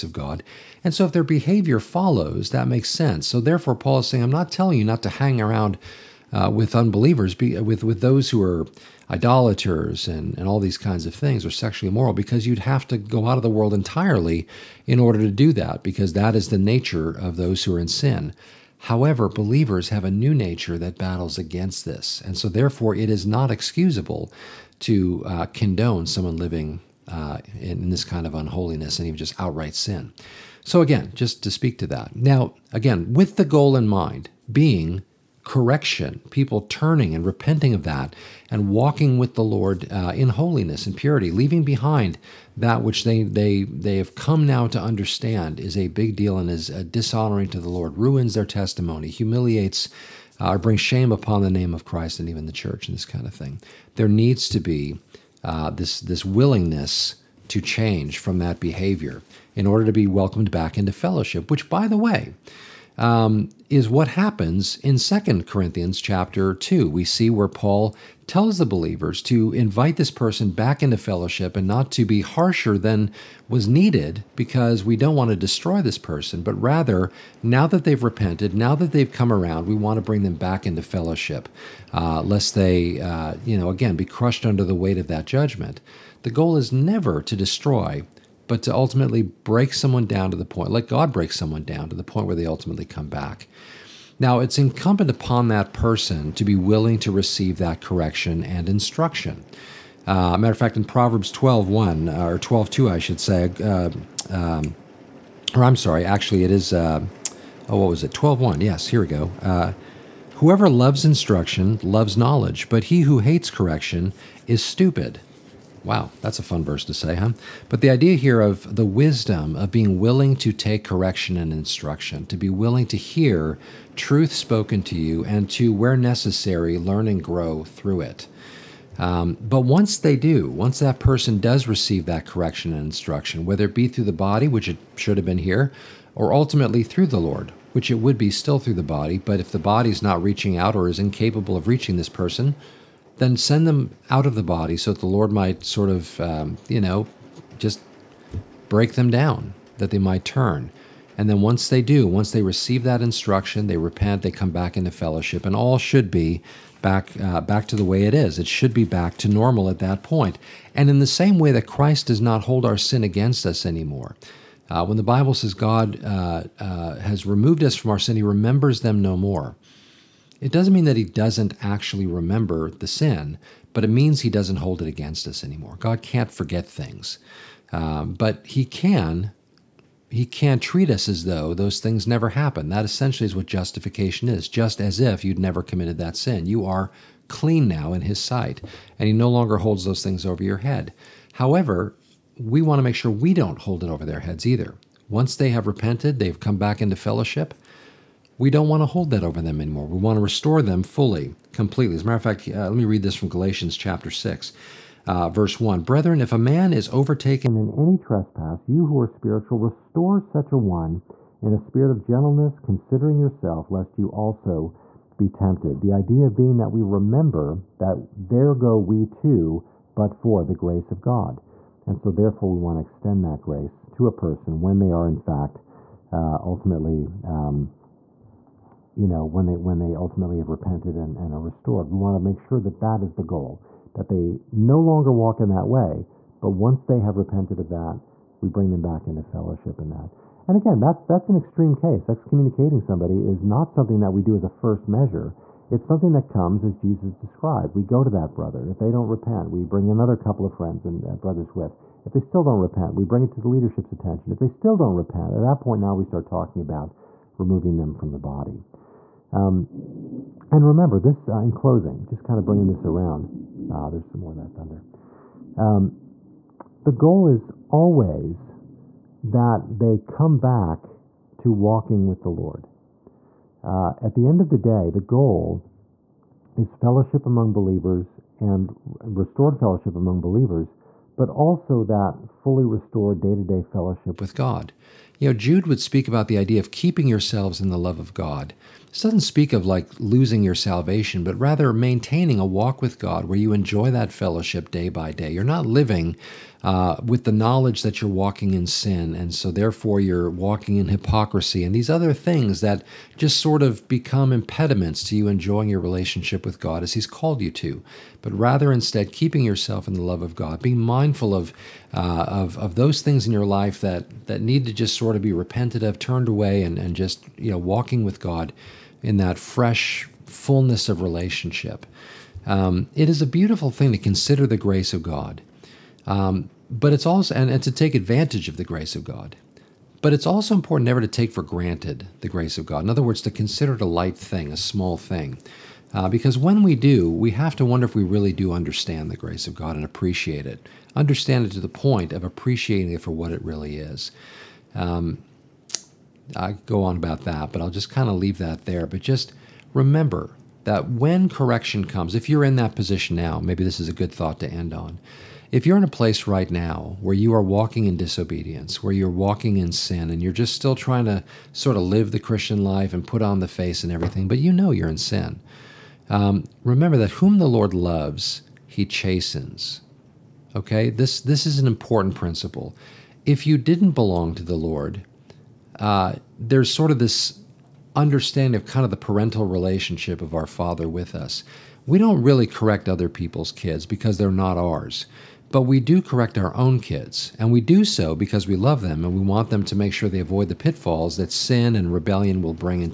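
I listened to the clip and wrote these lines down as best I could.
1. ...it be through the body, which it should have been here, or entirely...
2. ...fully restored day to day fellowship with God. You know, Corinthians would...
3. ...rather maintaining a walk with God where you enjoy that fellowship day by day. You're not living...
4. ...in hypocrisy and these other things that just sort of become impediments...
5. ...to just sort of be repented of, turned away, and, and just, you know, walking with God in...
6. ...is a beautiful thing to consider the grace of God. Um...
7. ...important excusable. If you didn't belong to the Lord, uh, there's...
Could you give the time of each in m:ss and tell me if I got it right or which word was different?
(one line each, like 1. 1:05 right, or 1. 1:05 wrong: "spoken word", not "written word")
1. 2:13 wrong: "ultimately", not "entirely"
2. 4:42 wrong: "Jude", not "Corinthians"
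3. 4:51 right
4. 5:00 right
5. 5:14 right
6. 5:23 right
7. 6:11 wrong: "principle", not "excusable".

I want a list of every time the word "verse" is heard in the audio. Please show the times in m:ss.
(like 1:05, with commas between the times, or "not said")
1:56, 3:25.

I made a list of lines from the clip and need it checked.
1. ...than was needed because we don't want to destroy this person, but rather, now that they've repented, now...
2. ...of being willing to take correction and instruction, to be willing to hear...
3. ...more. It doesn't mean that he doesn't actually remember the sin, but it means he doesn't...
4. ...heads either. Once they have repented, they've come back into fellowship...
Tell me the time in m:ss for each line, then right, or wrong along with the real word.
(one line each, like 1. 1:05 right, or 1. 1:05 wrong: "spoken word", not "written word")
1. 1:12 right
2. 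1:59 right
3. 2:49 right
4. 3:14 right.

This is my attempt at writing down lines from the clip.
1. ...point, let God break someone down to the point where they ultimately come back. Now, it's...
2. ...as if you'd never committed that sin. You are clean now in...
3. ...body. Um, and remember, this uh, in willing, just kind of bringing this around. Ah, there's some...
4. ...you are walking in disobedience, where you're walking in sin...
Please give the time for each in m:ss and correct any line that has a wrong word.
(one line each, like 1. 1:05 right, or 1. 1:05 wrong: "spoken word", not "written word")
1. 1:30 right
2. 3:04 right
3. 4:18 wrong: "closing", not "willing"
4. 5:57 right.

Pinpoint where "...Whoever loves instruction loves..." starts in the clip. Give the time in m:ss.
1:50.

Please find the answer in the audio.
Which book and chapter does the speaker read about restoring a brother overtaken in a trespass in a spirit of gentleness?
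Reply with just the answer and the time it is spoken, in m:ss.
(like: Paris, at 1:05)
Galatians chapter 6, at 3:23.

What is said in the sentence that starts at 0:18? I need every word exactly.
However, believers have a new nature that battles against this.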